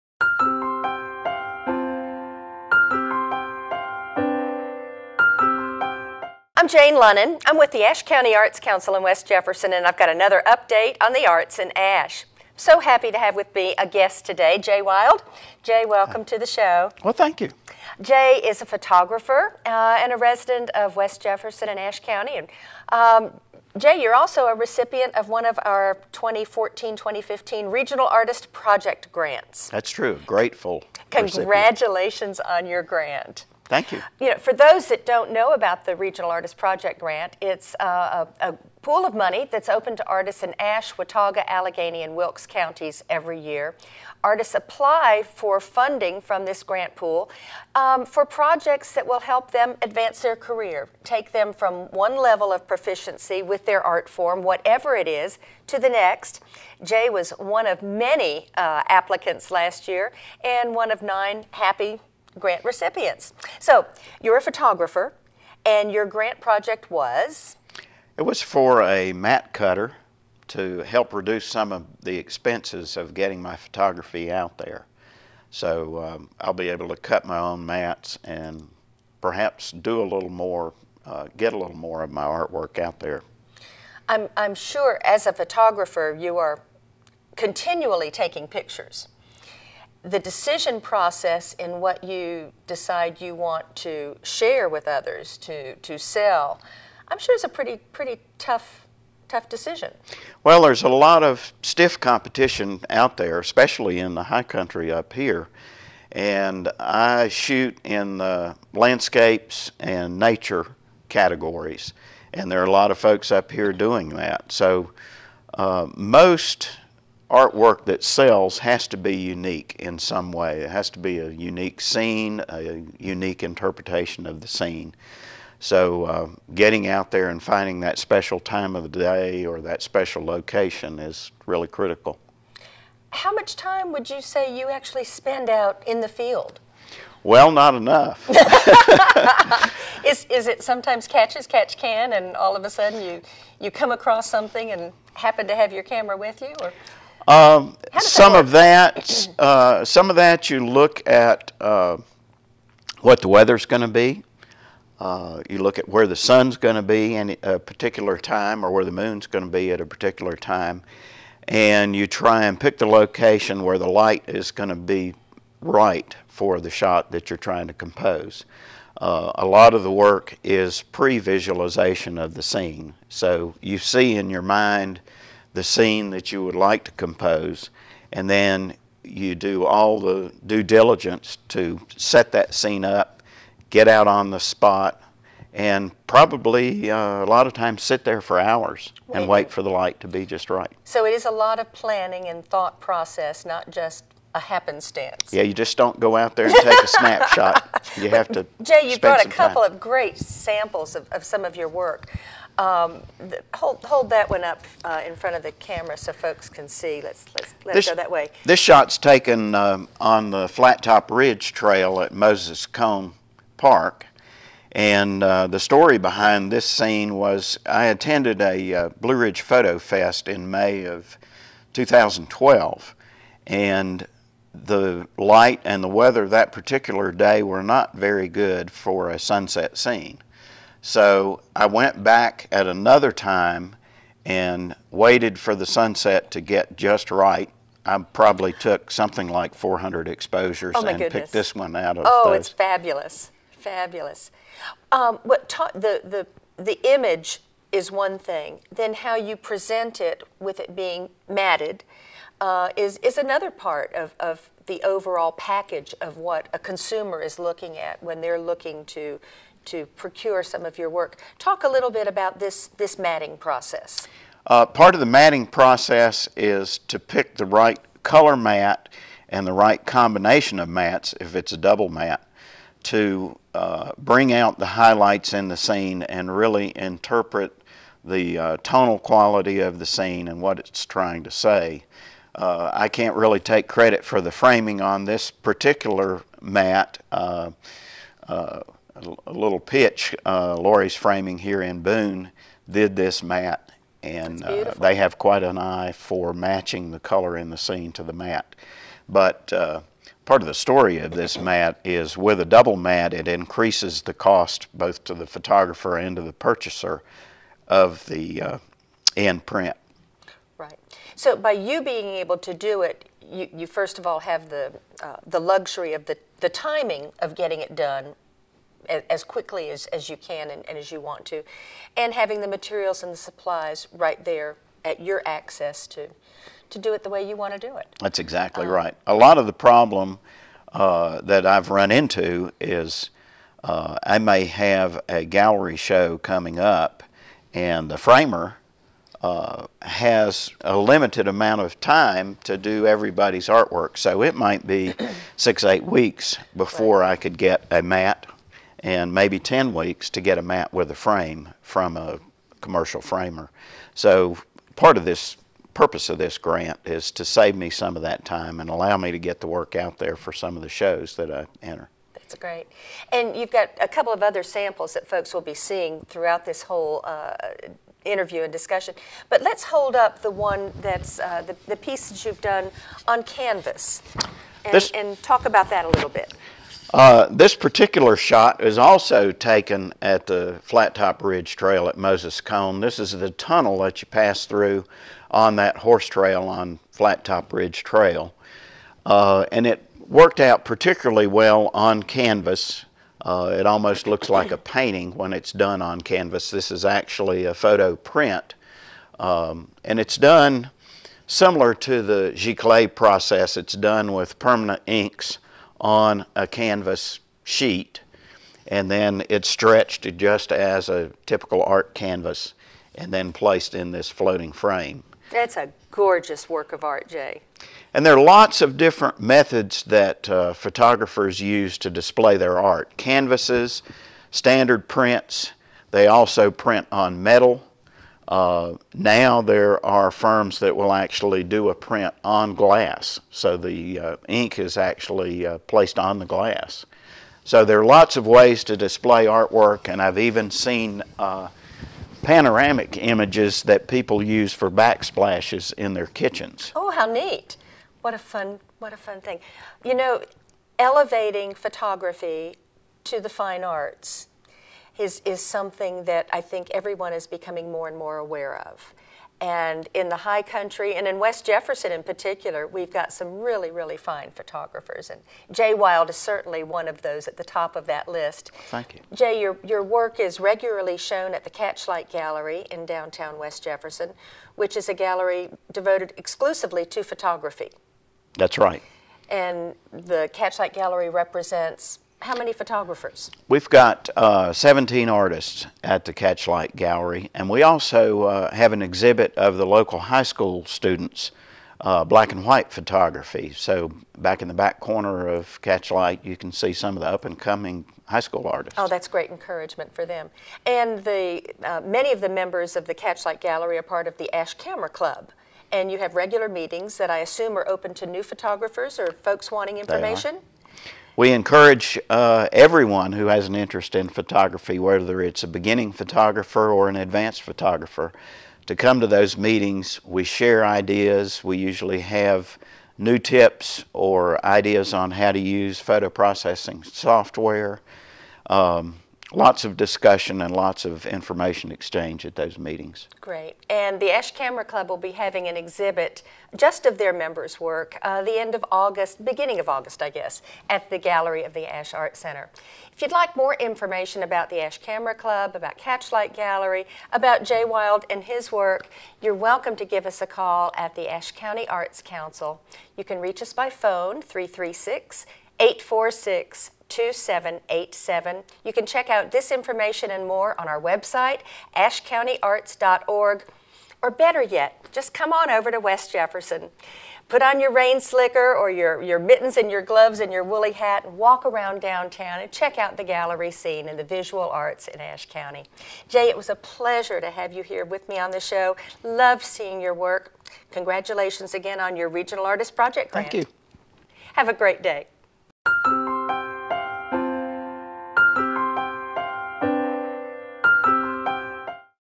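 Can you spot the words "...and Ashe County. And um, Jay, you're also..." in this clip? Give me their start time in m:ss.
0:21.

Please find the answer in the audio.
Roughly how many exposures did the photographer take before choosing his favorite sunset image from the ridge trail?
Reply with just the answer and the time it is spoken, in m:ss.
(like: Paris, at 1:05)
400, at 3:59.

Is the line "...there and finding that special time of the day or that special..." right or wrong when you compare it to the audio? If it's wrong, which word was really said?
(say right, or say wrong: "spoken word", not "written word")
right.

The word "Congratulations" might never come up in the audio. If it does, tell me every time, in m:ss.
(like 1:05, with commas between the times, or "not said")
0:31, 9:40.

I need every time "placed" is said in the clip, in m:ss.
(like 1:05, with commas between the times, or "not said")
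6:53, 7:15.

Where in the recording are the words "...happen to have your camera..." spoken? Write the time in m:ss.
2:25.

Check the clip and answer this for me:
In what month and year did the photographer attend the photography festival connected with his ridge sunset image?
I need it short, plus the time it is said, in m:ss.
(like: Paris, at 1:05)
May 2012, at 3:40.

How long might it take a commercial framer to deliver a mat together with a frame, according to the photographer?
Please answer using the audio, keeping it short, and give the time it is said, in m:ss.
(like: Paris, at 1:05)
10 weeks, at 5:49.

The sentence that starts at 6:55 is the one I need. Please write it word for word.
That's a gorgeous work of art, Jay.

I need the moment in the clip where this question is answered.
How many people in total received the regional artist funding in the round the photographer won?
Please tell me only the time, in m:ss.
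1:01.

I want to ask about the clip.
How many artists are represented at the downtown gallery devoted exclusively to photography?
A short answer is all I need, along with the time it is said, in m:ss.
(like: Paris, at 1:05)
17, at 8:04.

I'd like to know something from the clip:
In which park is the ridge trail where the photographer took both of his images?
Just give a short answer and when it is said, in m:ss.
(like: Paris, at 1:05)
Moses Cone Park, at 3:32.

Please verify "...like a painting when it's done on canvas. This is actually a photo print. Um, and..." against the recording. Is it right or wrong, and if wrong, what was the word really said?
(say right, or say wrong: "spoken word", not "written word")
right.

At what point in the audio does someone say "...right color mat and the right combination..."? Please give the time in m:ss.
4:27.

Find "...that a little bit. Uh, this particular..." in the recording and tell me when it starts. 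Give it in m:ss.
6:15.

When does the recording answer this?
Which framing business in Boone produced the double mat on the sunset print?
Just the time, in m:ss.
4:50.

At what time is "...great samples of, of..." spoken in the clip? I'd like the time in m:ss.
3:19.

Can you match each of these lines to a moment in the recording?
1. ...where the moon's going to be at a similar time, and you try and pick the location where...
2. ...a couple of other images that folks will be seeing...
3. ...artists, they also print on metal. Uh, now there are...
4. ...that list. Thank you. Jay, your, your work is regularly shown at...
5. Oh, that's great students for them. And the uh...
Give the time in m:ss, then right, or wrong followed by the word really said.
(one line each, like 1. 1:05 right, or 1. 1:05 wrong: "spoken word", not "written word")
1. 2:38 wrong: "particular", not "similar"
2. 6:03 wrong: "samples", not "images"
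3. 7:04 wrong: "prints", not "artists"
4. 7:47 right
5. 8:18 wrong: "encouragement", not "students".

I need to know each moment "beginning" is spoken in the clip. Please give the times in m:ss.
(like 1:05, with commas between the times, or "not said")
8:35, 8:59.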